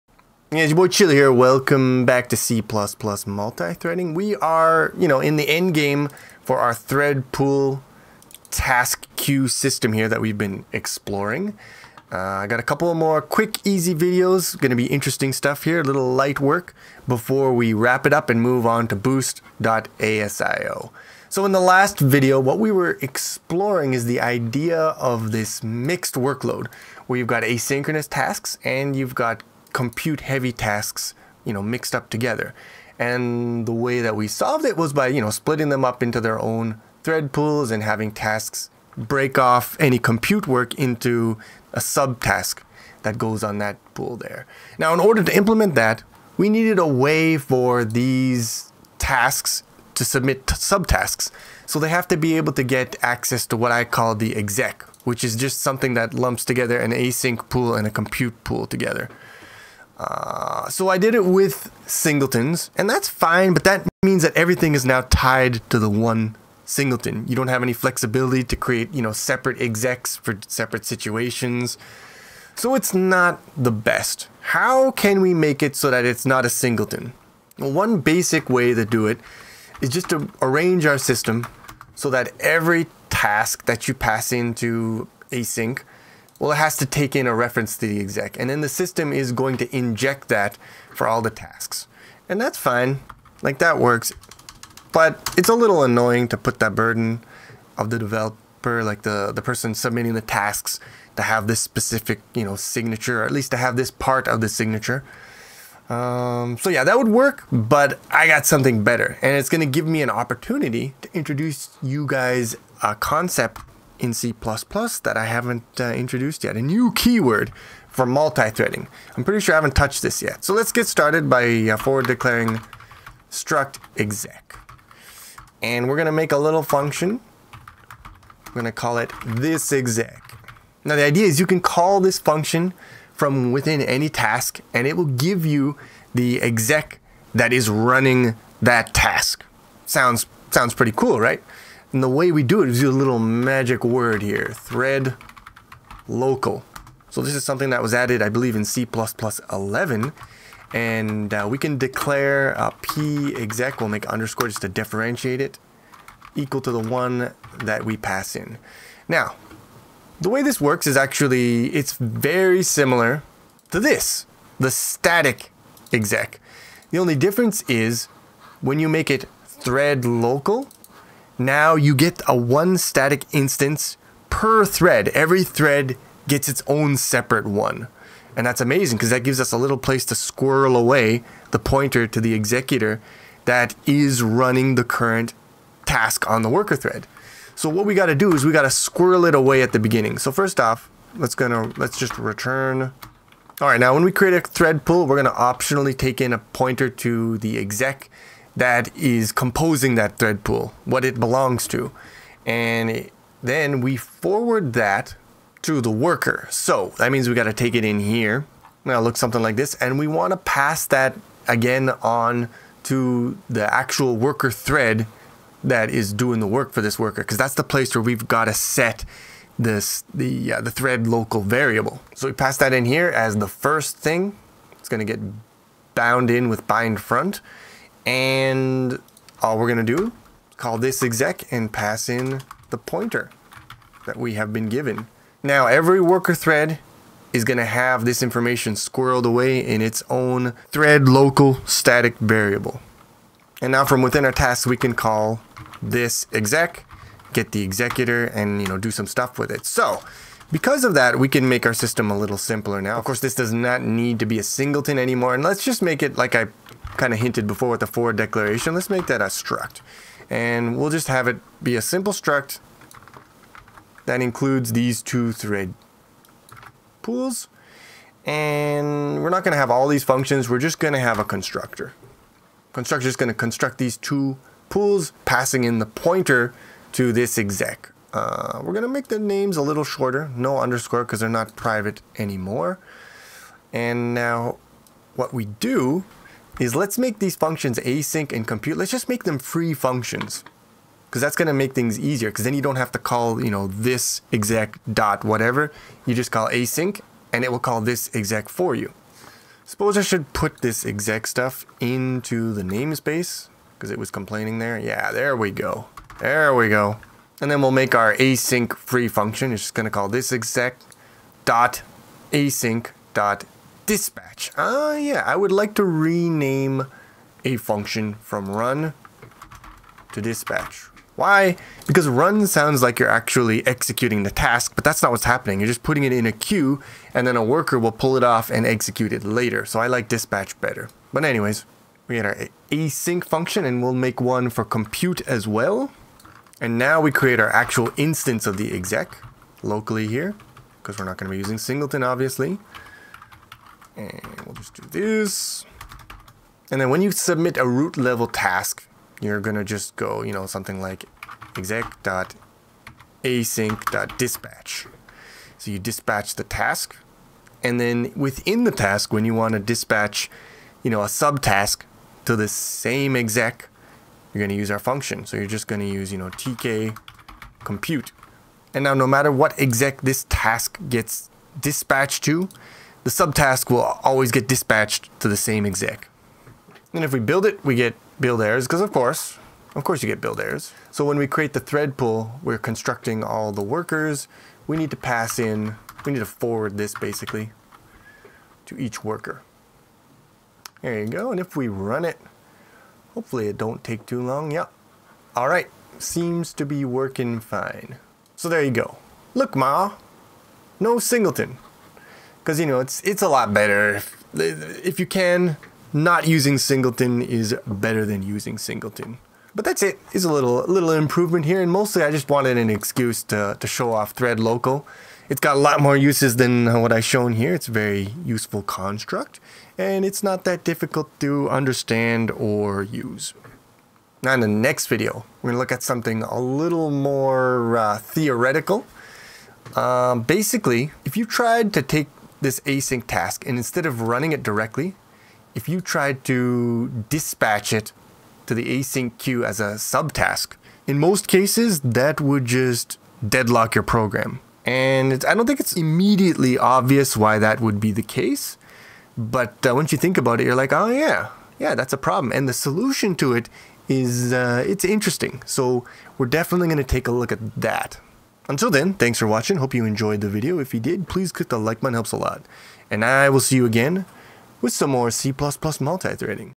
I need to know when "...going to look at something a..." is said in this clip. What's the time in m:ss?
7:05.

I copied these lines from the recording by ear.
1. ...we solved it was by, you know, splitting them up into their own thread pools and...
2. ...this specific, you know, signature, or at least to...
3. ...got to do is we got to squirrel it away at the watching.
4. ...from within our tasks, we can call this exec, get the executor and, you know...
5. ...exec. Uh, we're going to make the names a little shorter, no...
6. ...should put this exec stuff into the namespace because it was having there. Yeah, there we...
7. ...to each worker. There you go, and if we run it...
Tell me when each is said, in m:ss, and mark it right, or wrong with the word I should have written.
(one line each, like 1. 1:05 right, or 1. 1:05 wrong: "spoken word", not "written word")
1. 0:34 right
2. 1:41 right
3. 3:07 wrong: "beginning", not "watching"
4. 4:03 right
5. 4:37 right
6. 5:00 wrong: "complaining", not "having"
7. 6:28 right.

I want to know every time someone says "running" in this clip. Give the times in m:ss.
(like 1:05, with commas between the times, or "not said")
2:17, 3:04, 7:14.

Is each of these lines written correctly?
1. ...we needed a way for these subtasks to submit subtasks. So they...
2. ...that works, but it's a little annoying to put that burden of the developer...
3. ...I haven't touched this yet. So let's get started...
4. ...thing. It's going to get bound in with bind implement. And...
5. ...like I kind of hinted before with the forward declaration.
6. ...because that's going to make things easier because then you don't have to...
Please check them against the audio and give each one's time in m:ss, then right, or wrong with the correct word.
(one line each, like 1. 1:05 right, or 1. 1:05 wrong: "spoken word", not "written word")
1. 0:46 wrong: "tasks", not "subtasks"
2. 1:33 right
3. 1:59 right
4. 3:43 wrong: "front", not "implement"
5. 4:16 right
6. 4:51 right.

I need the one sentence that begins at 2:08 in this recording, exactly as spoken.
I'm gonna call it this exec.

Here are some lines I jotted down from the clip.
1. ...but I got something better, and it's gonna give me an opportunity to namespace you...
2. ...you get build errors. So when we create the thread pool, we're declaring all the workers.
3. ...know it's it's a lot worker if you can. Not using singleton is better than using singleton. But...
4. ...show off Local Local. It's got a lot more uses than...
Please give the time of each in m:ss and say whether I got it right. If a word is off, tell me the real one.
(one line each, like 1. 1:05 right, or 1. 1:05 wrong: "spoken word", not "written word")
1. 1:47 wrong: "introduce", not "namespace"
2. 6:20 wrong: "constructing", not "declaring"
3. 6:42 wrong: "better", not "worker"
4. 6:53 wrong: "Thread", not "Local".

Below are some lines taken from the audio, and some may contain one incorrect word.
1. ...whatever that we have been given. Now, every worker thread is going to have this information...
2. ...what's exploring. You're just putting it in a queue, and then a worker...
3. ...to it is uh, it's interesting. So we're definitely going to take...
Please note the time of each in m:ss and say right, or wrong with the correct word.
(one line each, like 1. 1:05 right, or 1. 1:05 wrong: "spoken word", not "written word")
1. 3:52 wrong: "pointer", not "whatever"
2. 5:25 wrong: "happening", not "exploring"
3. 7:33 right.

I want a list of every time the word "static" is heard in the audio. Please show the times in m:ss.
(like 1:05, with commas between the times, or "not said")
2:44, 2:52, 4:01.